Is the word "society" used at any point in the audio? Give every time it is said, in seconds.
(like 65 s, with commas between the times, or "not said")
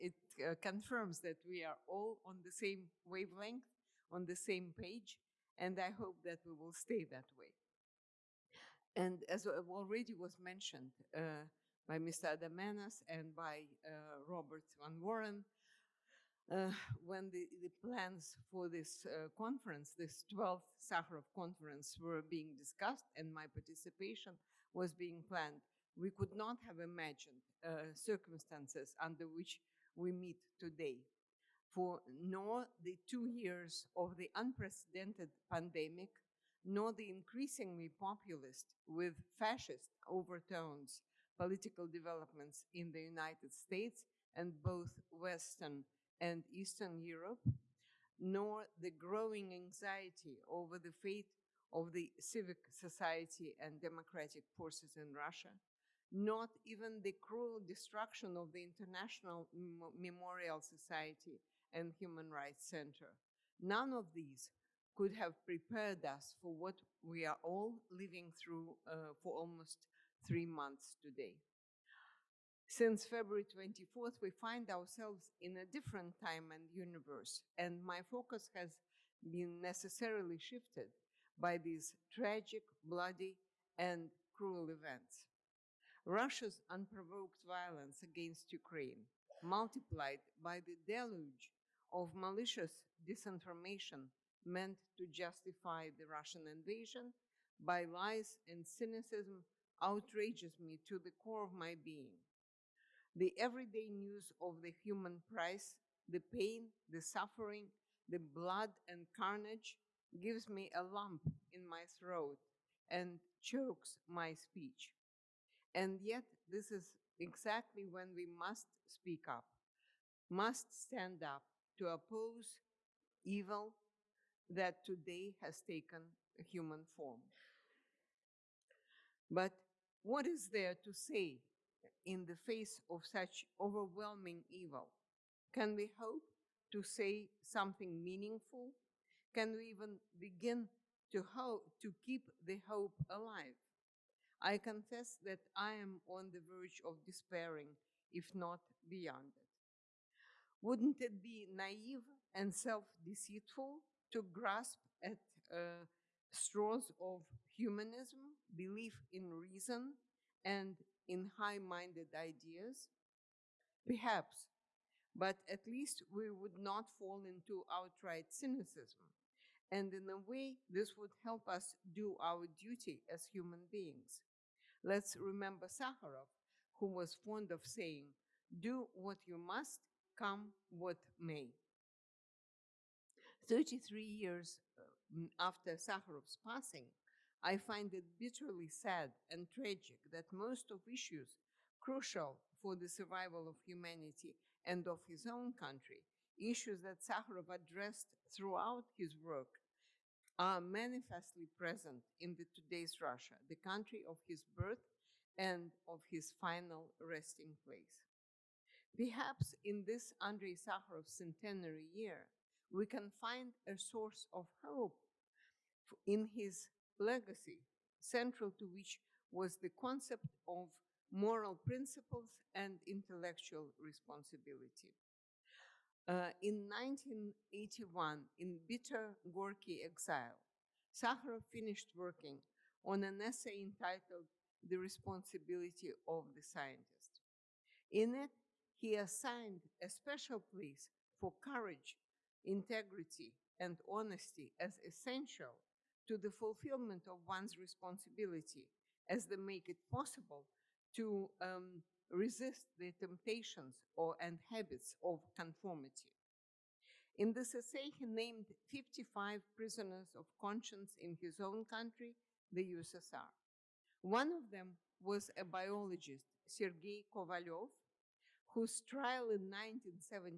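52 s, 60 s.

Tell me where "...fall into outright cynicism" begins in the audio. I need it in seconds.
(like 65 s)
166 s.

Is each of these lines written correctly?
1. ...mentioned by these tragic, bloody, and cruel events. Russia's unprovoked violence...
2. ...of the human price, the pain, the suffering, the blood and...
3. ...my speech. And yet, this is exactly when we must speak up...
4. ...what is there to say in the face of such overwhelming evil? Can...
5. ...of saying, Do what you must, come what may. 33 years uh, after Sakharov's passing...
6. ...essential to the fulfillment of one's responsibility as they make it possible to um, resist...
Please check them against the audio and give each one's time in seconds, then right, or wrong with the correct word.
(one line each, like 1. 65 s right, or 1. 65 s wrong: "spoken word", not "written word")
1. 80 s wrong: "shifted", not "mentioned"
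2. 104 s right
3. 114 s right
4. 130 s right
5. 177 s right
6. 244 s right.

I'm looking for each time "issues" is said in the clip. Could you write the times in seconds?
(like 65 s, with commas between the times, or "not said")
190 s, 196 s.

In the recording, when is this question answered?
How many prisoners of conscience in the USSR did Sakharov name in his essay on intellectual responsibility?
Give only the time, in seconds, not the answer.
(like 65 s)
258 s.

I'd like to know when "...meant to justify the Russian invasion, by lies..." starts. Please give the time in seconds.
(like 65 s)
94 s.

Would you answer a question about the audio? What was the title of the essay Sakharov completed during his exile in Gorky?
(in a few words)
The Responsibility of the Scientist.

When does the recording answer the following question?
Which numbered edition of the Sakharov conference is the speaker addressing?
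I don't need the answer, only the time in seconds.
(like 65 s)
20 s.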